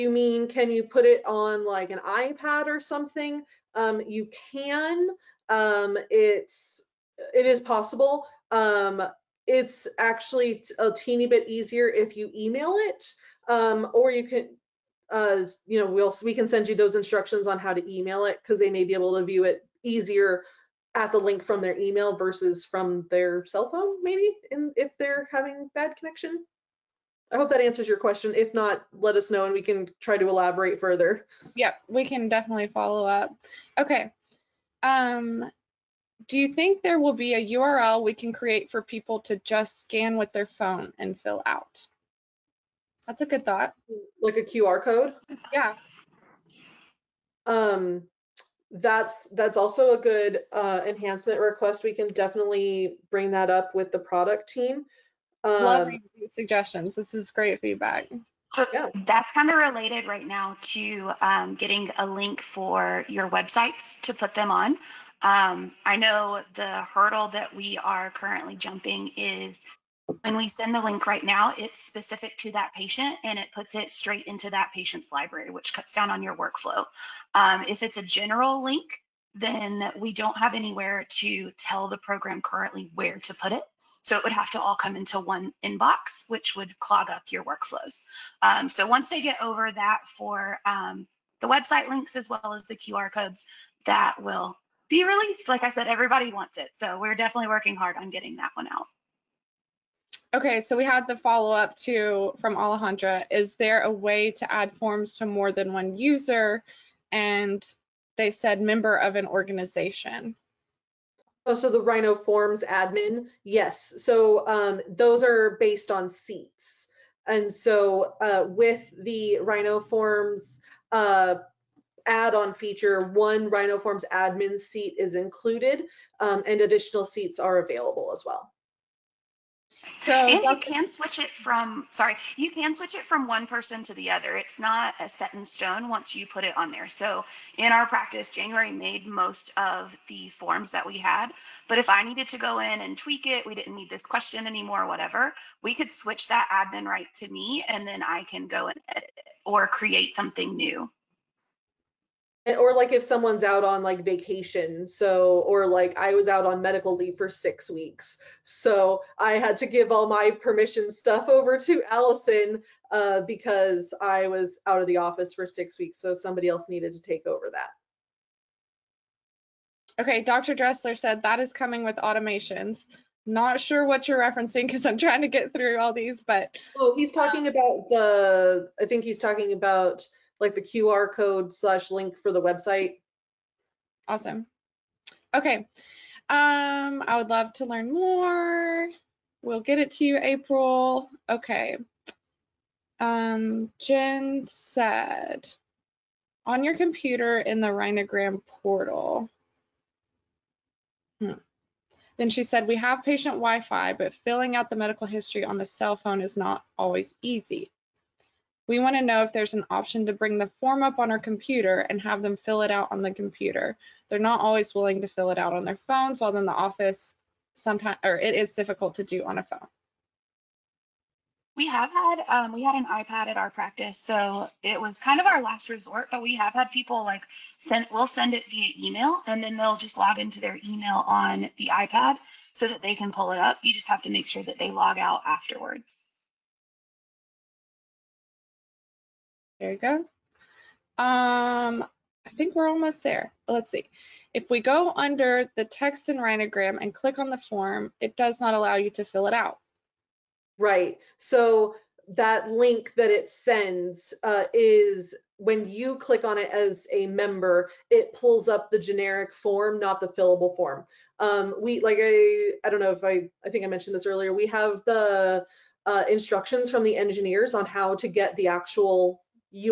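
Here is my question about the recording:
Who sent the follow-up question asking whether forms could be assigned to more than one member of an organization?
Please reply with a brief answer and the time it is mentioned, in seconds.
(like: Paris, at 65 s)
Alejandra, at 102 s.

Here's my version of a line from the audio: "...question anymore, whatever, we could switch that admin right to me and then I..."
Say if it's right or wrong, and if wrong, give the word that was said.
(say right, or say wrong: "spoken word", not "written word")
right.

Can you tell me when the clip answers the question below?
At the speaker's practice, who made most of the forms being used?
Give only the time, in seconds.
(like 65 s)
138 s.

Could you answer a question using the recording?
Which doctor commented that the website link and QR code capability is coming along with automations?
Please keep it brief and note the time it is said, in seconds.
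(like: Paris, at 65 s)
Dr. Dressler, at 170 s.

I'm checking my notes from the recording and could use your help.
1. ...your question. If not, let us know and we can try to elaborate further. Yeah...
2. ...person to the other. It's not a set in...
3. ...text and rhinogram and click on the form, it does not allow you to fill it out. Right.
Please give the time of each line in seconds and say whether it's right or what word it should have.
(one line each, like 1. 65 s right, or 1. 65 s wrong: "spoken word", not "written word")
1. 27 s right
2. 133 s right
3. 245 s right.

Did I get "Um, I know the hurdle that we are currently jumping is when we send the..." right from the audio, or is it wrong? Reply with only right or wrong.
right.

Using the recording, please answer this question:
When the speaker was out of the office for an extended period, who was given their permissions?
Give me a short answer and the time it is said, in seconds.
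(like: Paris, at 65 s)
Allison, at 161 s.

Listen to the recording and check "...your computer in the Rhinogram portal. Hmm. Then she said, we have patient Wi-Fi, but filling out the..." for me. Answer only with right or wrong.
right.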